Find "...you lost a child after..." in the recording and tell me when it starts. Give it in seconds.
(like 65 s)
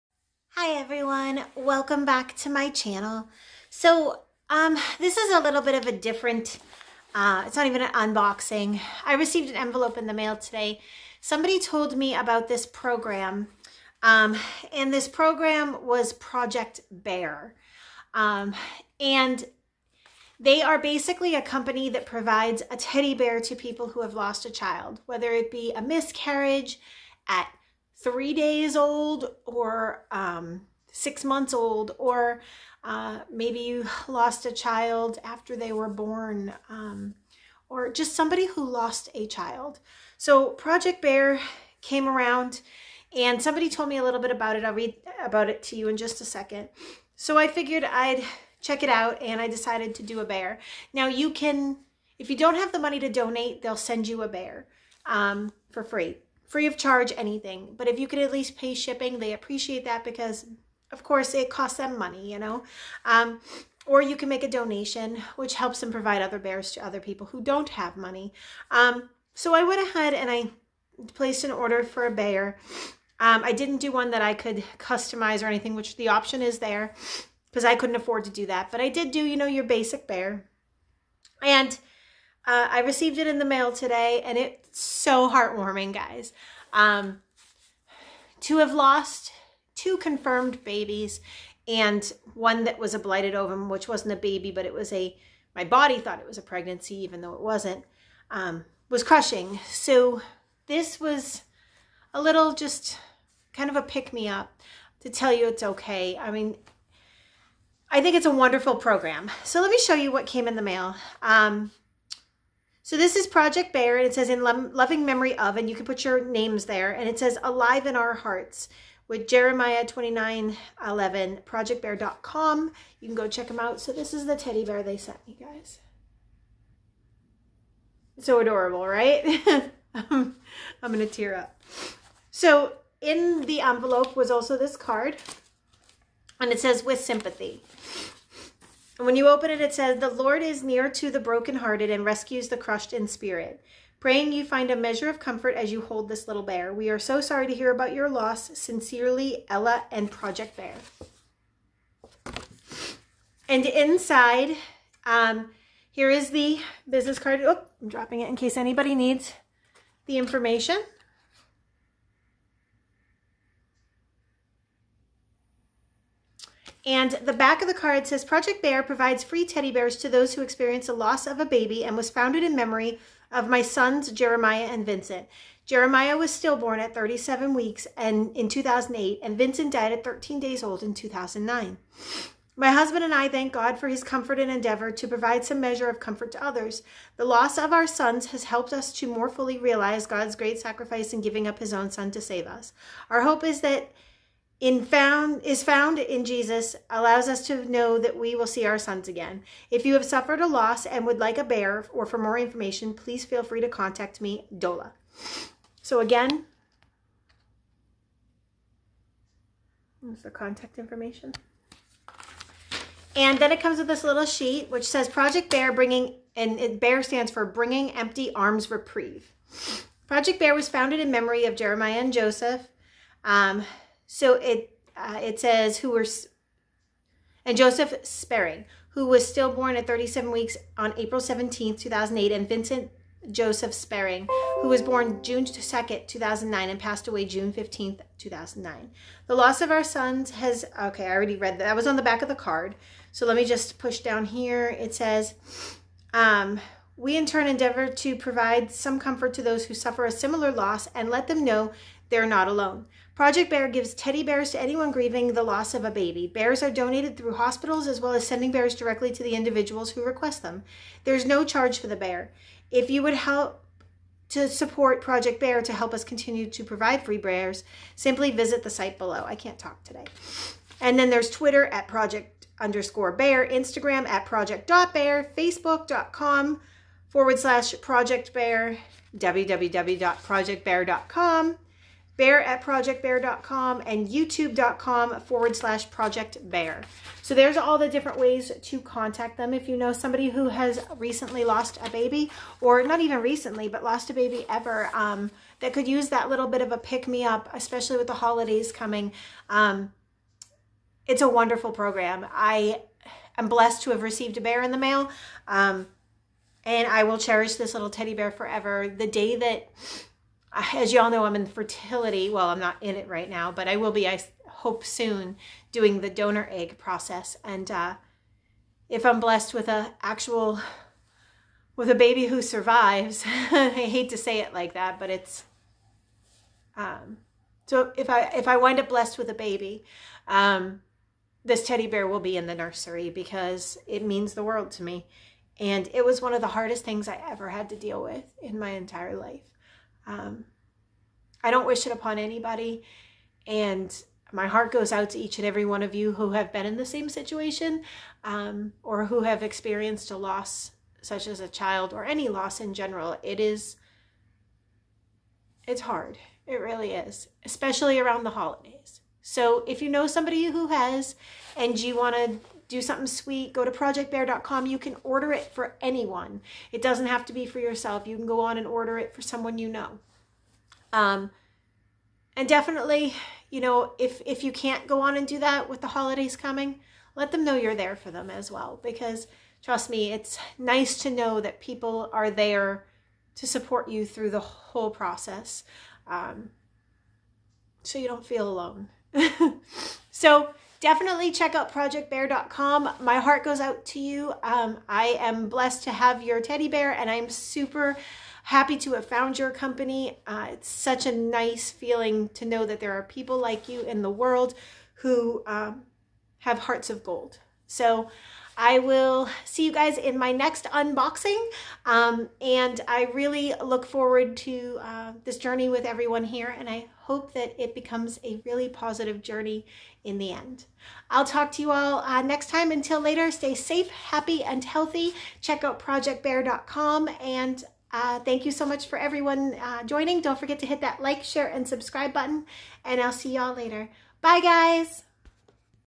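33 s.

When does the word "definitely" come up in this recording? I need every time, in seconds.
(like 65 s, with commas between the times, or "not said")
372 s, 390 s.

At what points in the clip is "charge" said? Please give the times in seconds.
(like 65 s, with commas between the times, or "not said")
56 s, 261 s.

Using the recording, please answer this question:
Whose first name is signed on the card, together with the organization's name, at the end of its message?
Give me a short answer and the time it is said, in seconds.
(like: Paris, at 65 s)
Ella, at 149 s.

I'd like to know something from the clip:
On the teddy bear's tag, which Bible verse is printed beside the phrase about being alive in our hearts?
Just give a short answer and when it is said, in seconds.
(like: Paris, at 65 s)
Jeremiah 29:11, at 119 s.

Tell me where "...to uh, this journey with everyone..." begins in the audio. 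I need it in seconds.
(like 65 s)
414 s.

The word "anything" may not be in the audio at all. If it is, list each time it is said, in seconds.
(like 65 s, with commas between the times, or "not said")
57 s, 75 s.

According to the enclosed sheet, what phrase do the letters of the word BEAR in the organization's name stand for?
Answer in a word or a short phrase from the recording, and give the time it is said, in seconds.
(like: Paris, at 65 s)
Bringing Empty Arms Reprieve, at 217 s.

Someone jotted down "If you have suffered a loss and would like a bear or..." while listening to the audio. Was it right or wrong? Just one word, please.
right.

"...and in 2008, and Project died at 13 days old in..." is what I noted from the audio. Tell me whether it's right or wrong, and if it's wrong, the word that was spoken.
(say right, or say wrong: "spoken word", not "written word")
wrong: "Vincent", not "Project".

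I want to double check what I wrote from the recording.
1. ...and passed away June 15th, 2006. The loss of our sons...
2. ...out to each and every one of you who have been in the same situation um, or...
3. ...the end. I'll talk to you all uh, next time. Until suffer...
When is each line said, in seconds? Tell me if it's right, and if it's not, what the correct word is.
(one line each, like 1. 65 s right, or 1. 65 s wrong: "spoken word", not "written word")
1. 236 s wrong: "2009", not "2006"
2. 344 s right
3. 420 s wrong: "later", not "suffer".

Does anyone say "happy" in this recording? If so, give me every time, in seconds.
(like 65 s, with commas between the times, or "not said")
398 s, 423 s.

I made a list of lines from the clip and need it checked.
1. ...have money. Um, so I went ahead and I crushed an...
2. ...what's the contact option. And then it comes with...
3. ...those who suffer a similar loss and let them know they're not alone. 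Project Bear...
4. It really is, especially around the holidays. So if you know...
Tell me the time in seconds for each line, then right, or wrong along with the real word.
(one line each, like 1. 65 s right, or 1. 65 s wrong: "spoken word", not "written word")
1. 67 s wrong: "placed", not "crushed"
2. 210 s wrong: "information", not "option"
3. 249 s right
4. 356 s right.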